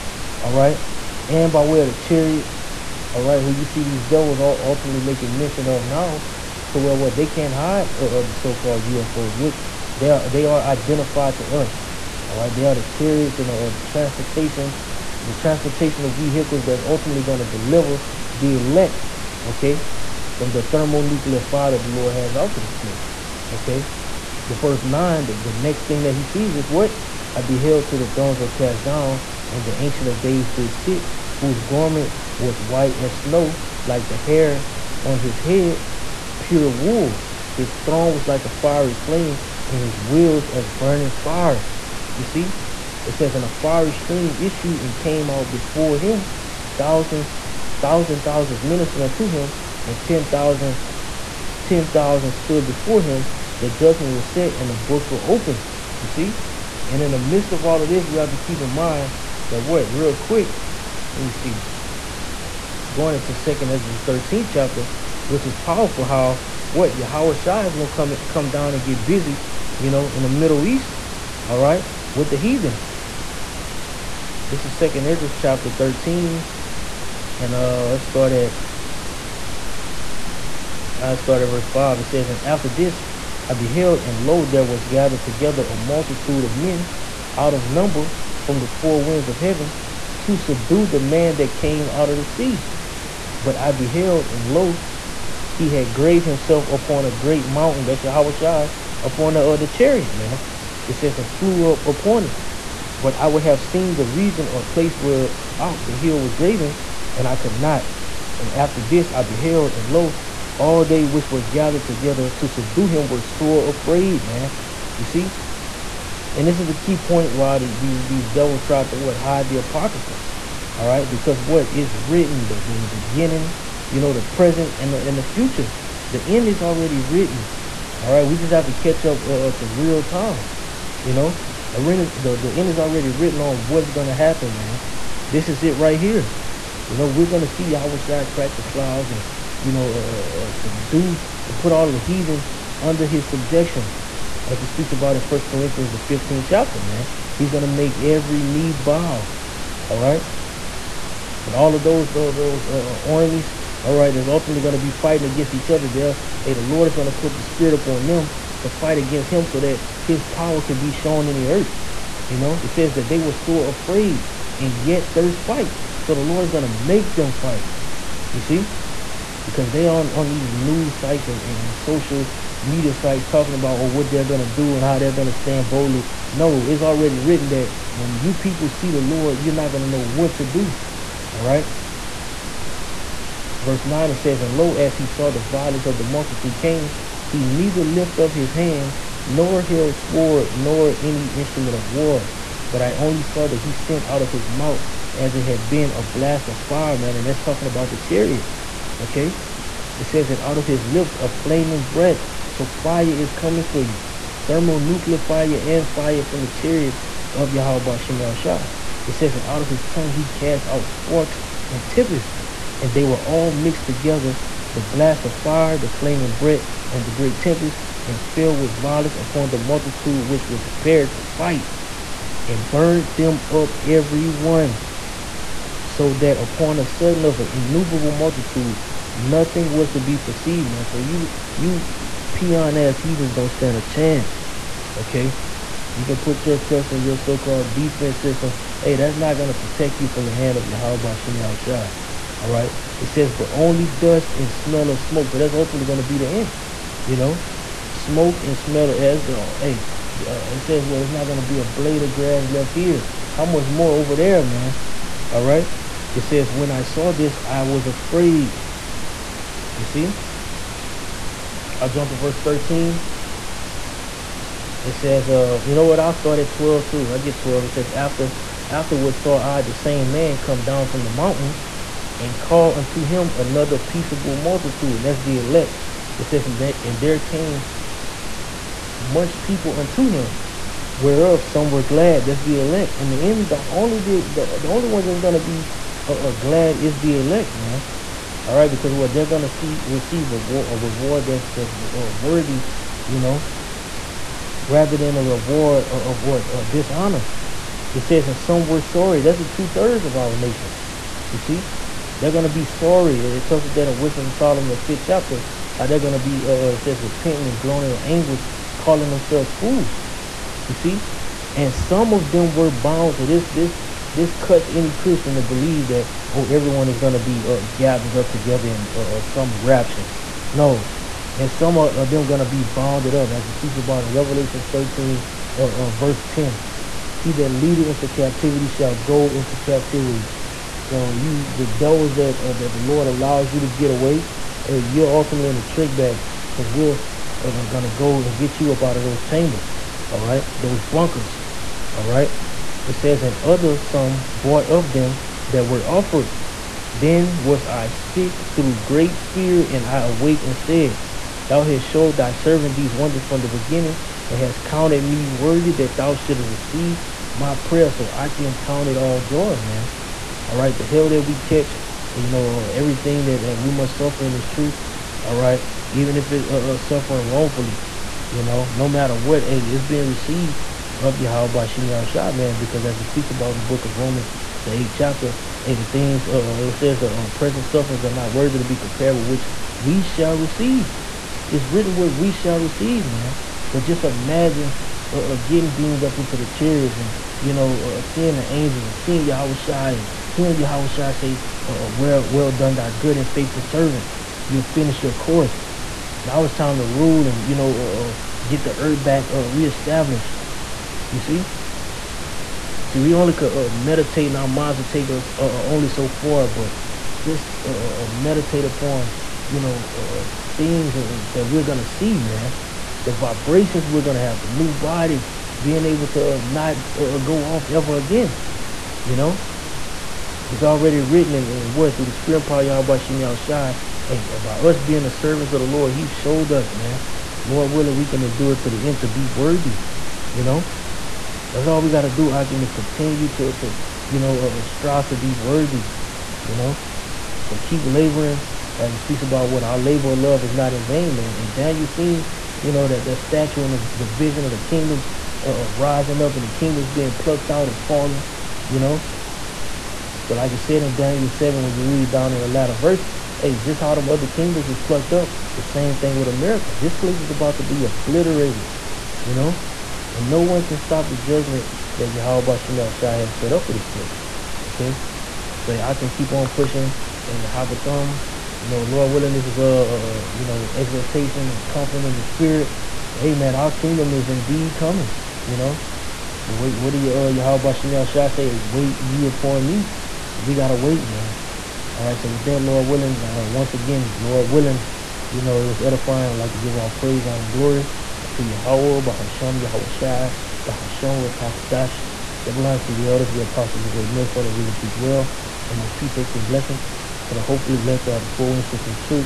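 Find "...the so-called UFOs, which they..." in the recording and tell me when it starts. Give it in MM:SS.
00:08.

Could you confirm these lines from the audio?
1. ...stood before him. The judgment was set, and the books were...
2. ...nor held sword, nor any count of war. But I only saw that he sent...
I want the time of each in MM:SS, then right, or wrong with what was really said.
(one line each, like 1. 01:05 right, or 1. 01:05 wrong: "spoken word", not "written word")
1. 00:52 right
2. 03:09 wrong: "instrument", not "count".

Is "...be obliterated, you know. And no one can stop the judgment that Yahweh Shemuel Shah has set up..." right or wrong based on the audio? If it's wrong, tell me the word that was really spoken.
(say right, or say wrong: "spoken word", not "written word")
right.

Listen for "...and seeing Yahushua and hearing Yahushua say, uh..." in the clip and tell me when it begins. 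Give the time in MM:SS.
06:28.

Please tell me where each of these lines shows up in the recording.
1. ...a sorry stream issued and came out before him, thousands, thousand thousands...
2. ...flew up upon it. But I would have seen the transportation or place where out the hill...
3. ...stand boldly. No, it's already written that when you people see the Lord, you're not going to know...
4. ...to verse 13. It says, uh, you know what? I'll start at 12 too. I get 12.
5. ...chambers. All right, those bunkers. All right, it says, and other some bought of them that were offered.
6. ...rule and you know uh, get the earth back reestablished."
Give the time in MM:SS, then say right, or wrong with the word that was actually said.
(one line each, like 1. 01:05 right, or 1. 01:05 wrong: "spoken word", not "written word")
1. 00:43 wrong: "fiery", not "sorry"
2. 01:41 wrong: "region", not "transportation"
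3. 02:55 right
4. 04:22 right
5. 05:39 right
6. 06:36 right.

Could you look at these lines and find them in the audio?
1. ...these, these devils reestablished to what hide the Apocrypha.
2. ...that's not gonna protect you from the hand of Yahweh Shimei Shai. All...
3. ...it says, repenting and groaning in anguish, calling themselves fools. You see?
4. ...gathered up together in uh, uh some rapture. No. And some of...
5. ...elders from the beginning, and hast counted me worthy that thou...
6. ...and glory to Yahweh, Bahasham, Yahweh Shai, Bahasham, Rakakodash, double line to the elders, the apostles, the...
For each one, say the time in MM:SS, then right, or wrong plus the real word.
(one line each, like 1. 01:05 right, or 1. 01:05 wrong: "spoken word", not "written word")
1. 01:57 wrong: "tried", not "reestablished"
2. 03:58 right
3. 05:06 right
4. 05:17 right
5. 05:52 wrong: "wonders", not "elders"
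6. 08:07 right.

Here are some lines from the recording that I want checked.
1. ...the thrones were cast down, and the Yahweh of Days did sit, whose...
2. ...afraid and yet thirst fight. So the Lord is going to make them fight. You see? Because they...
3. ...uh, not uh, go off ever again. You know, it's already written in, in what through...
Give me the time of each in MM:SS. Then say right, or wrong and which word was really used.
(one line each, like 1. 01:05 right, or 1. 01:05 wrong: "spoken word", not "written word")
1. 00:27 wrong: "Ancient", not "Yahweh"
2. 02:43 right
3. 06:56 right.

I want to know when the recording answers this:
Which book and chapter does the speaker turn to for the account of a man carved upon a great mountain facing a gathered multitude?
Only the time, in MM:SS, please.
01:03.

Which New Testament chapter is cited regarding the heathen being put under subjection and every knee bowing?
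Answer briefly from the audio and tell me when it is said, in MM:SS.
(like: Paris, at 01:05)
First Corinthians 15, at 02:25.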